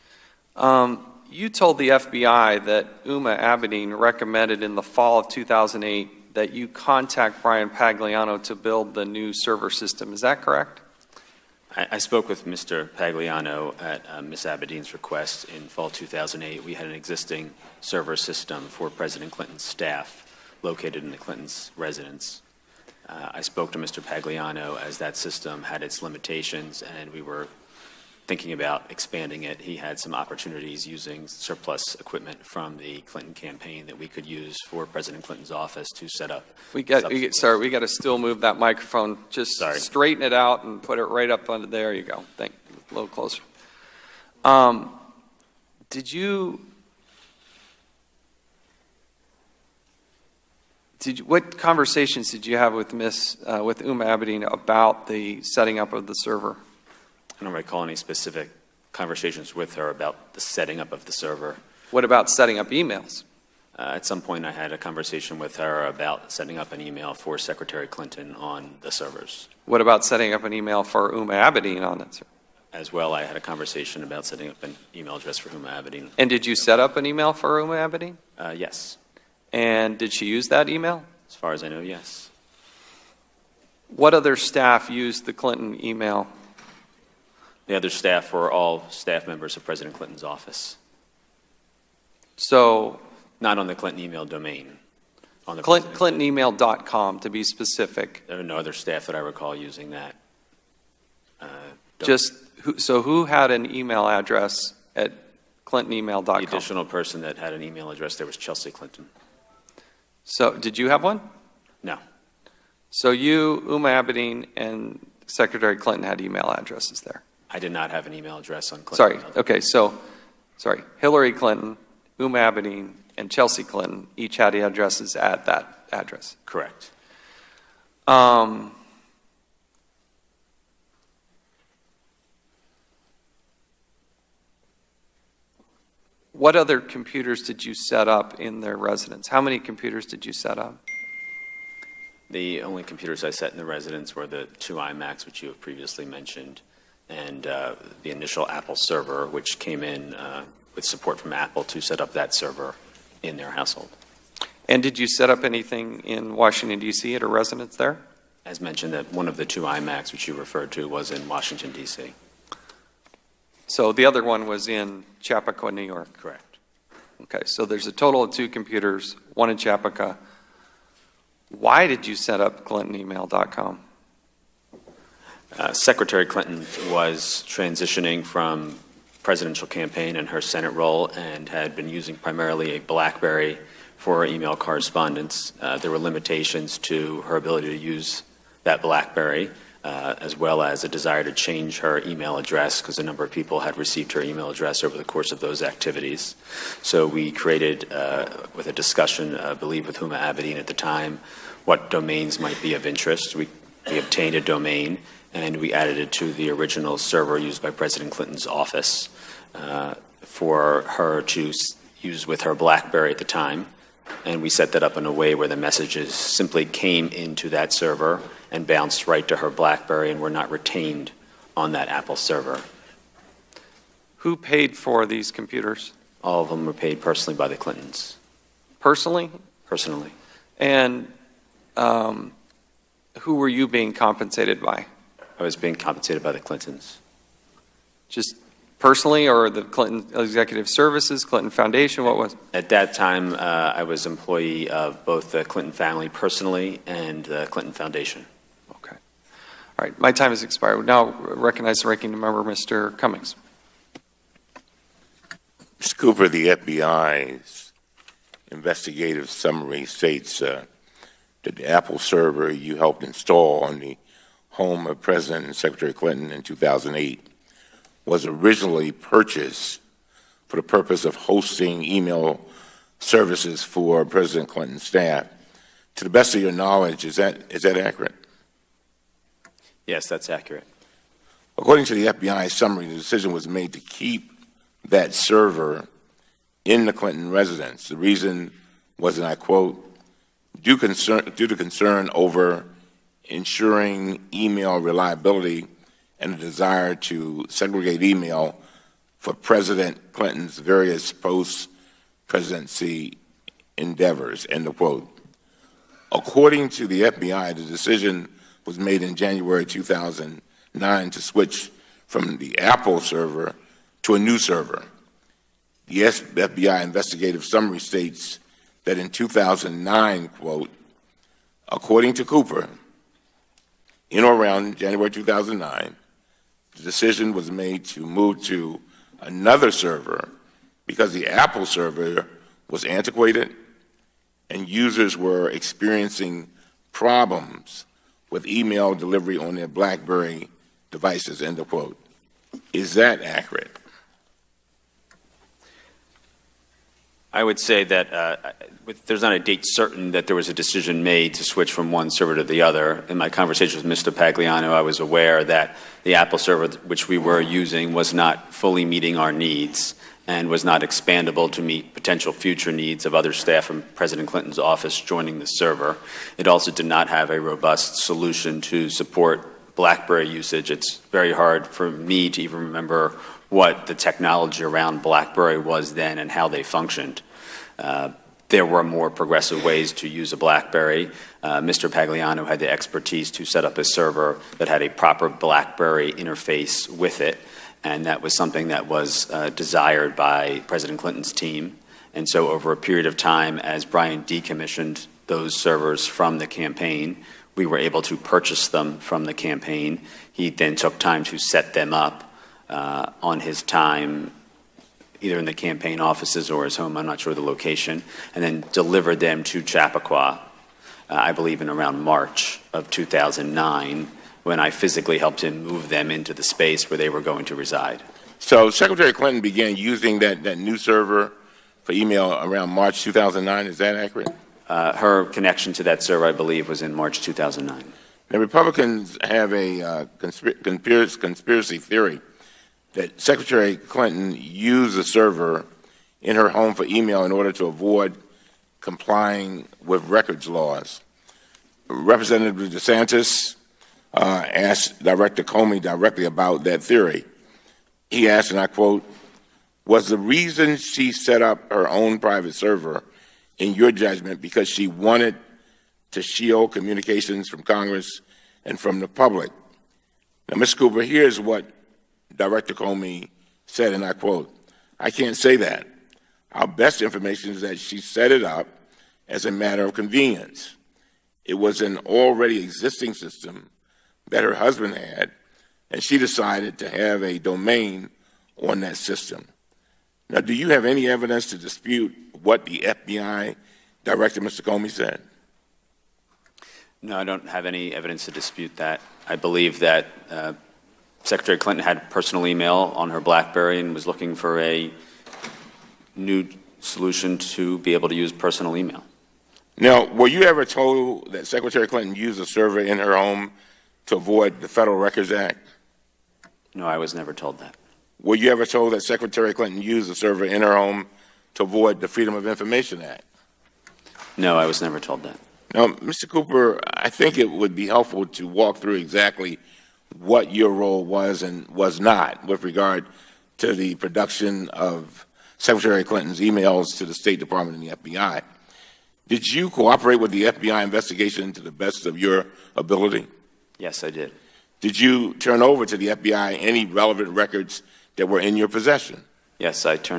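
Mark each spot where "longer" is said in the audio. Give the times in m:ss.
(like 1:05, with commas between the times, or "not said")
not said.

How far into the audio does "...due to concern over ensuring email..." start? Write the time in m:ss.
4:51.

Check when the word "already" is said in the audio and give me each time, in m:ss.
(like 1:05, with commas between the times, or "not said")
7:51.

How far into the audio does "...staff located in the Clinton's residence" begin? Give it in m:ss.
0:19.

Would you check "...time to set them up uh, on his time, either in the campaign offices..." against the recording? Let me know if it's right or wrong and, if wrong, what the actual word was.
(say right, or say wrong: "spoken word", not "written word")
right.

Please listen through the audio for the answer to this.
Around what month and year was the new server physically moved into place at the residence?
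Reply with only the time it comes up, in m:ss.
6:52.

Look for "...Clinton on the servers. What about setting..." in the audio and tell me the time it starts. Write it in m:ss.
1:07.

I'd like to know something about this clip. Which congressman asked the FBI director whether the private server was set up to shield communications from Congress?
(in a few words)
DeSantis.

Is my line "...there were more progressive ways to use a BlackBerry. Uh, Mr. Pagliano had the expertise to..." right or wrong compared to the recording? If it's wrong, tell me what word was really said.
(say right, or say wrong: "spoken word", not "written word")
right.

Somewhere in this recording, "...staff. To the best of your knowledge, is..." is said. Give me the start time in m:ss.
4:34.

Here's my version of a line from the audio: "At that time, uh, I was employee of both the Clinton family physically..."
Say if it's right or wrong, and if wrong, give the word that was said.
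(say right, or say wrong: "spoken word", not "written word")
wrong: "personally", not "physically".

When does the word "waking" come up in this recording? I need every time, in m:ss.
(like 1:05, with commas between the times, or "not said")
not said.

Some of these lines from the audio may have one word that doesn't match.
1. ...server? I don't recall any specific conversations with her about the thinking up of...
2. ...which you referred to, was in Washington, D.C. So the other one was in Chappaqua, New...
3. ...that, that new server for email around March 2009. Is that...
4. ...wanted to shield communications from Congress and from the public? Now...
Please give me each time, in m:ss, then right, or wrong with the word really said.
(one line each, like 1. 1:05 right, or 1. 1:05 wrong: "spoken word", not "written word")
1. 0:56 wrong: "setting", not "thinking"
2. 2:40 right
3. 7:00 right
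4. 7:34 right.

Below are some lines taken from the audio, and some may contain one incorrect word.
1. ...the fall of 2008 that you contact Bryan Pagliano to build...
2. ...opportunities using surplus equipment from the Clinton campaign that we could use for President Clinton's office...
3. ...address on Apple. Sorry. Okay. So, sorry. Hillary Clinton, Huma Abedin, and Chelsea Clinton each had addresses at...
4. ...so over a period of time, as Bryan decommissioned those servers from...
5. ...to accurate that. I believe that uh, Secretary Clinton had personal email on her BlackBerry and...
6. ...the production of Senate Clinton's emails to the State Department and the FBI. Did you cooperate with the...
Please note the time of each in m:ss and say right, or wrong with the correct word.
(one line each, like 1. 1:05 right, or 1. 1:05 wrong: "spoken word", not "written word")
1. 0:04 right
2. 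0:30 right
3. 1:58 wrong: "Clinton", not "Apple"
4. 6:32 right
5. 8:08 wrong: "dispute", not "accurate"
6. 8:43 wrong: "Secretary", not "Senate".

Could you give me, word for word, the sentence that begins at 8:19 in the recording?
Now, were you ever told that Secretary Clinton used a server in her home to avoid the Federal Records Act?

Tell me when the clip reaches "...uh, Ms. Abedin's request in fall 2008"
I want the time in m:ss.
0:14.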